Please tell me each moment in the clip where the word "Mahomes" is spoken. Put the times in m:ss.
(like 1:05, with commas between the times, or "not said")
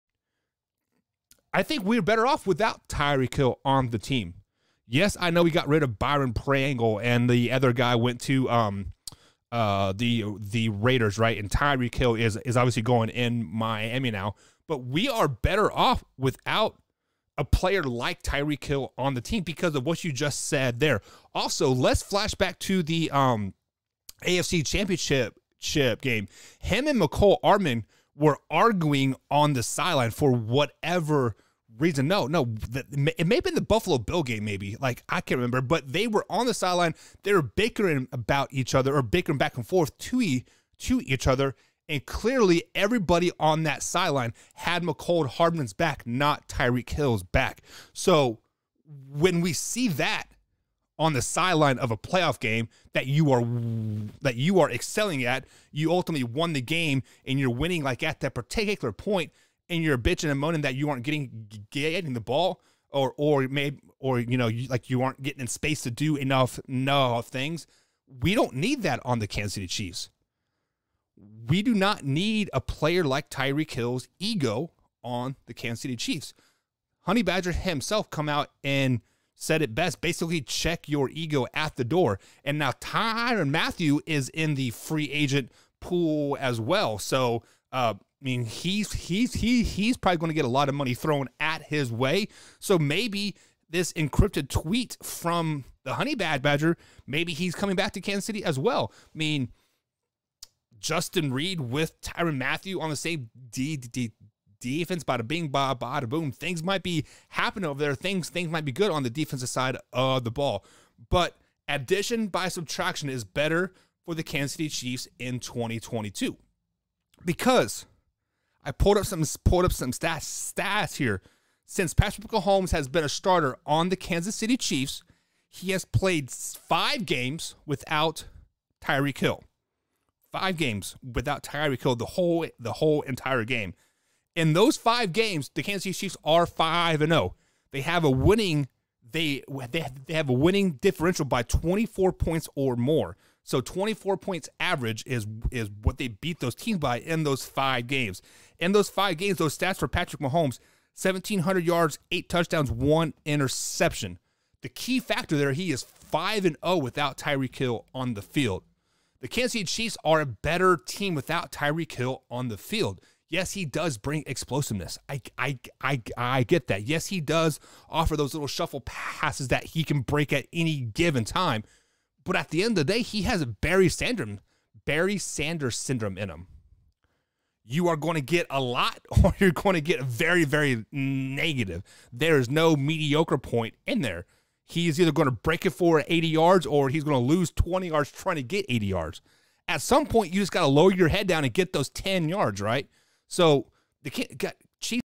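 2:02, 2:30.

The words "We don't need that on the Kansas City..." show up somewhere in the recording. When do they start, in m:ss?
1:08.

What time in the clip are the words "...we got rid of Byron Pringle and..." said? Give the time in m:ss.
0:05.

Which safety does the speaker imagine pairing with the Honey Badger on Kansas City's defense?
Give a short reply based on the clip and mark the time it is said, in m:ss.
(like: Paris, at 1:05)
Justin Reid, at 1:40.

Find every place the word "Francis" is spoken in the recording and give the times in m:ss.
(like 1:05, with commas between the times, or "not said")
not said.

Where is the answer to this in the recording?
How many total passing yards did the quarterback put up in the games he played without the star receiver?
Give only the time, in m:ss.
2:31.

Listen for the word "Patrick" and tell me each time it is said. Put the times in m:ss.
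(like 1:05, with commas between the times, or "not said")
2:01, 2:29.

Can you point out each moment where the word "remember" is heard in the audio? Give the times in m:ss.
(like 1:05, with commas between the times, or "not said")
0:35.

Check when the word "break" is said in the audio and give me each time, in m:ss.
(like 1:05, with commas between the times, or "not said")
2:50, 3:05.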